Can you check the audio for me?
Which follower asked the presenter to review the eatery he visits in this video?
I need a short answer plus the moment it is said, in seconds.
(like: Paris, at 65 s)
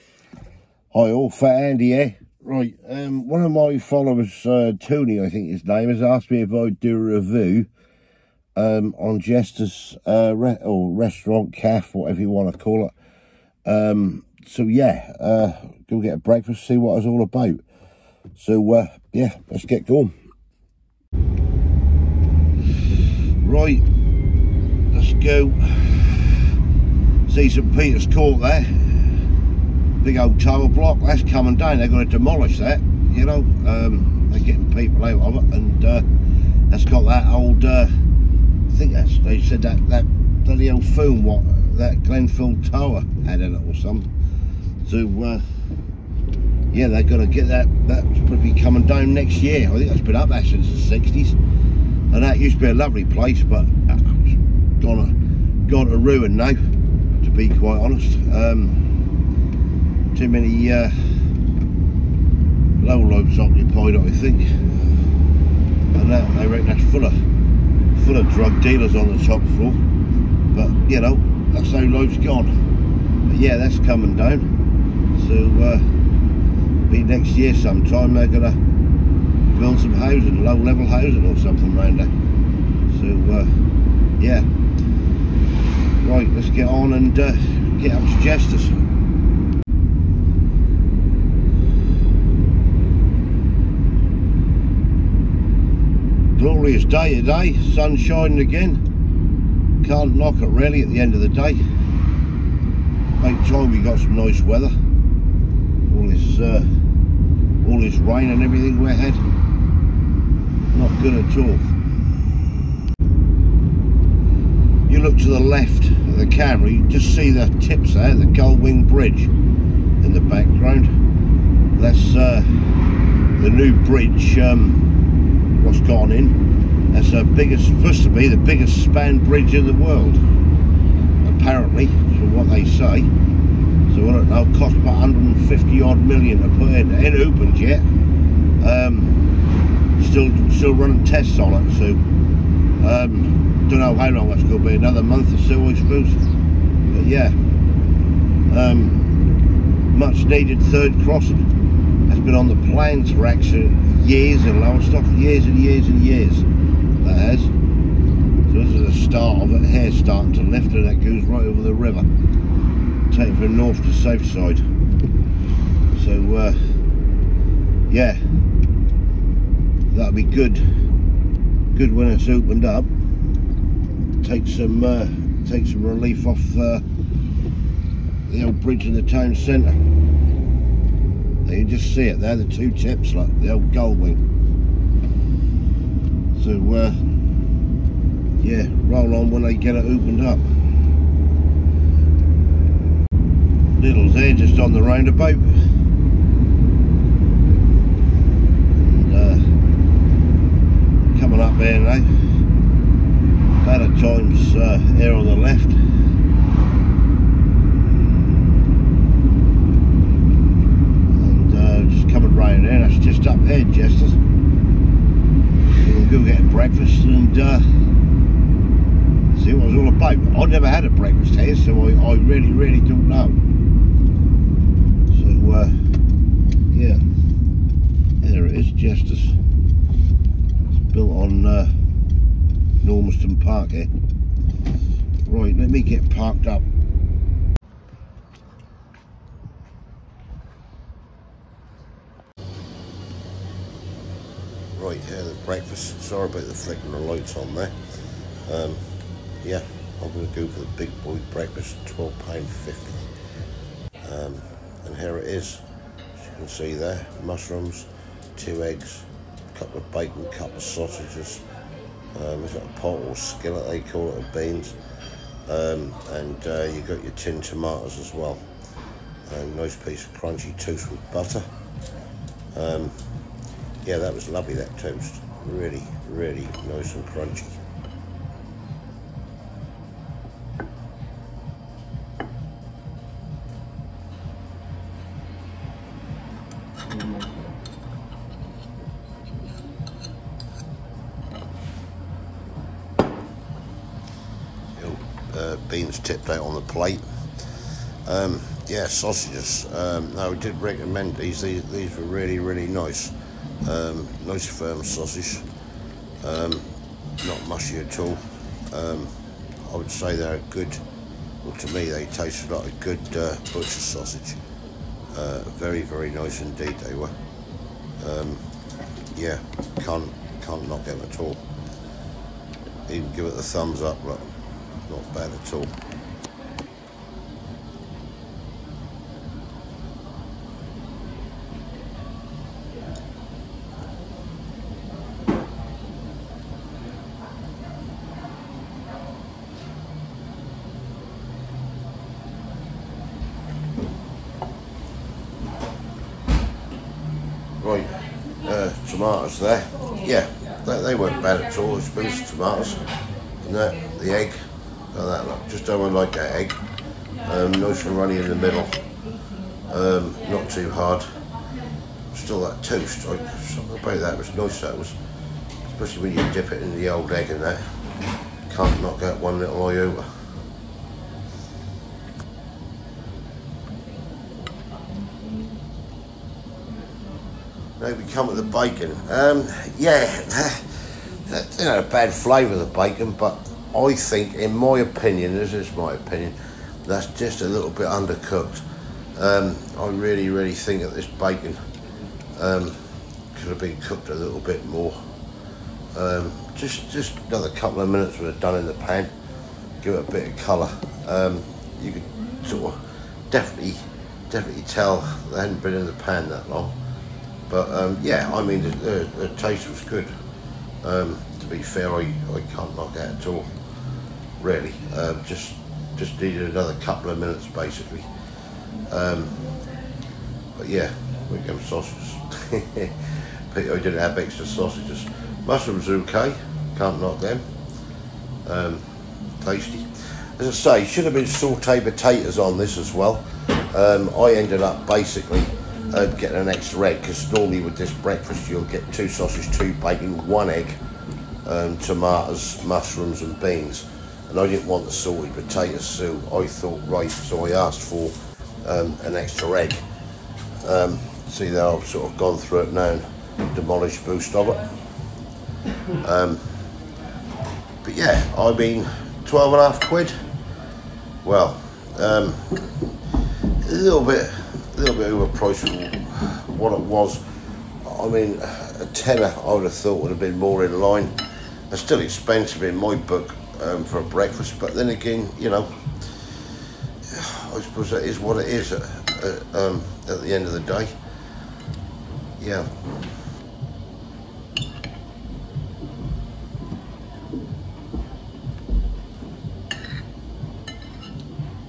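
Tony, at 4 s.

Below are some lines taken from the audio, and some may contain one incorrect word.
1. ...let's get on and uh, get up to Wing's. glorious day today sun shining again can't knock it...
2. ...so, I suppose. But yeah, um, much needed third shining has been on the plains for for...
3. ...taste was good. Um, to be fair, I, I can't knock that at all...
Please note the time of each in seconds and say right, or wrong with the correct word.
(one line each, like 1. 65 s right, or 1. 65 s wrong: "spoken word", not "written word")
1. 86 s wrong: "Jester", not "Wing"
2. 145 s wrong: "crossing", not "shining"
3. 409 s right.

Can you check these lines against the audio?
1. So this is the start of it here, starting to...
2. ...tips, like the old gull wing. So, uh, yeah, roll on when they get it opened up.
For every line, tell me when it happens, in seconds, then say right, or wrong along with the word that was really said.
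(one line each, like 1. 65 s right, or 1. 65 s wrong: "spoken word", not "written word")
1. 157 s right
2. 182 s right.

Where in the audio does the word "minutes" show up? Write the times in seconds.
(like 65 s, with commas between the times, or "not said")
397 s, 417 s.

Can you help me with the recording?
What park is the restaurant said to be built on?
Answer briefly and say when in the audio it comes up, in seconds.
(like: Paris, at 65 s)
Normanston Park, at 232 s.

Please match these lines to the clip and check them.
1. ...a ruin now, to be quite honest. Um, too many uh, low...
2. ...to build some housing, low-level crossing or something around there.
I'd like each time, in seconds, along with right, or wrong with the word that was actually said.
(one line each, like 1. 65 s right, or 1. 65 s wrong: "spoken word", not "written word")
1. 55 s right
2. 78 s wrong: "housing", not "crossing".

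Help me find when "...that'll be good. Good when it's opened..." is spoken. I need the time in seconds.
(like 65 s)
169 s.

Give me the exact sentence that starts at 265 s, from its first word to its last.
Um, and uh, you got your tin tomatoes as well.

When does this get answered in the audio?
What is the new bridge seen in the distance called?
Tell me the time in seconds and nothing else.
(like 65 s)
118 s.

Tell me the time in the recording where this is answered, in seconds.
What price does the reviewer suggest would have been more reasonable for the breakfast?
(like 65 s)
468 s.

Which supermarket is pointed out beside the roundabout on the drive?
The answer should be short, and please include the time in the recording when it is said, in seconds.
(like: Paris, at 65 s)
Lidl, at 193 s.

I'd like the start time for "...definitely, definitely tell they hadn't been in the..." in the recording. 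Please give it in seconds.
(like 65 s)
403 s.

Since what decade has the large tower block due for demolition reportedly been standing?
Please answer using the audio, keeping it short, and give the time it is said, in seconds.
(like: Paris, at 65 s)
the 60s, at 51 s.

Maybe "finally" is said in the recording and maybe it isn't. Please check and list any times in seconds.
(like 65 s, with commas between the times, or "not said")
not said.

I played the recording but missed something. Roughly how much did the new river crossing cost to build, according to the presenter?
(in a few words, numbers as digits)
150 odd million.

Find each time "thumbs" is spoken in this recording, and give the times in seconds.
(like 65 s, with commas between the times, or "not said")
323 s.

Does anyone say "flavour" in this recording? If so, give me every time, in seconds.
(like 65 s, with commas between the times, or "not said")
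382 s.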